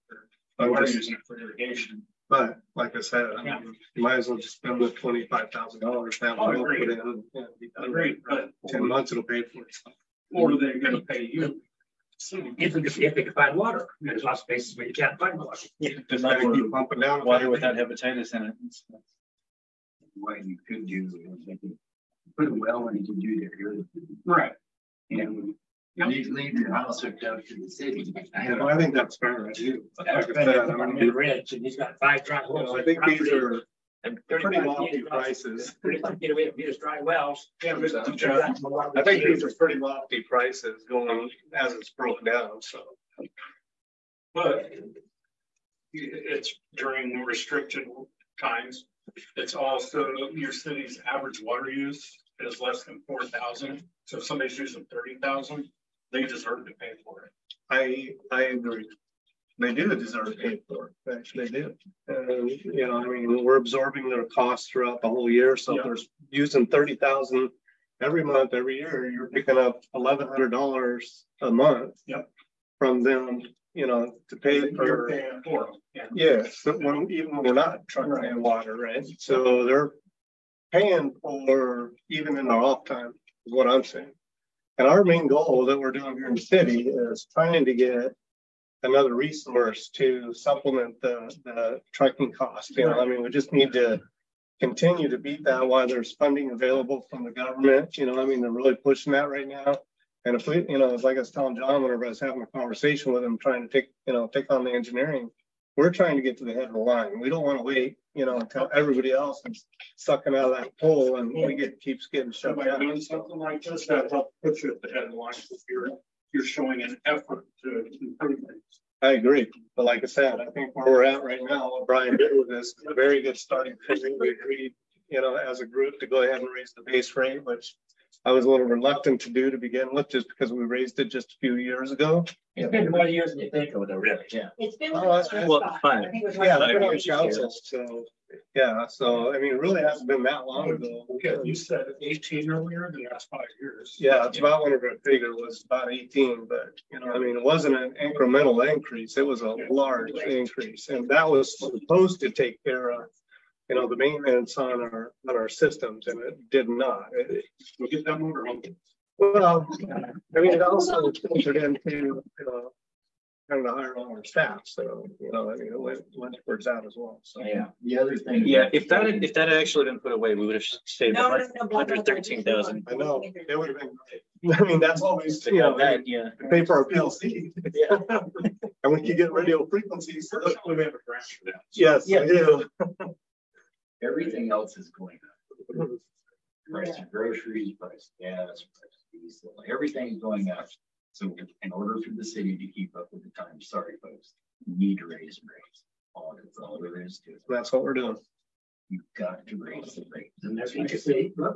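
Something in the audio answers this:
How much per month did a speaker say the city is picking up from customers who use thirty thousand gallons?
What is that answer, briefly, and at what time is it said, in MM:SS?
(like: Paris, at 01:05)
$1,100, at 01:09.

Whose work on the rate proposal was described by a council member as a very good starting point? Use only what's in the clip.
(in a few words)
Brian.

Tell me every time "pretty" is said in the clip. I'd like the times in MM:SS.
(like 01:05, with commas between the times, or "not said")
00:34, 00:39.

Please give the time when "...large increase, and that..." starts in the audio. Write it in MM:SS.
02:29.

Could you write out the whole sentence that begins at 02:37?
It- we get that motor home.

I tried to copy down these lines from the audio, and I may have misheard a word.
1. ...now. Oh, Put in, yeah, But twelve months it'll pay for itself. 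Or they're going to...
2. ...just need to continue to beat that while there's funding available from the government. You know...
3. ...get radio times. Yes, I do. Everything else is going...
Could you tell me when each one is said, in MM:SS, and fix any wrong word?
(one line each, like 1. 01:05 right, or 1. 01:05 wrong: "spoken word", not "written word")
1. 00:06 wrong: "ten", not "twelve"
2. 01:33 right
3. 02:59 wrong: "frequencies", not "times".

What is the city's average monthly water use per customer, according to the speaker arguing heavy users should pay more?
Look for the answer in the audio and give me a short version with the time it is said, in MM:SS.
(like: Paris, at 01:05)
less than 4,000, at 00:52.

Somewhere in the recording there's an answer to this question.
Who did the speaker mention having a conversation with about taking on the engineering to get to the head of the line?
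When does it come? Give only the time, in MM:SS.
01:41.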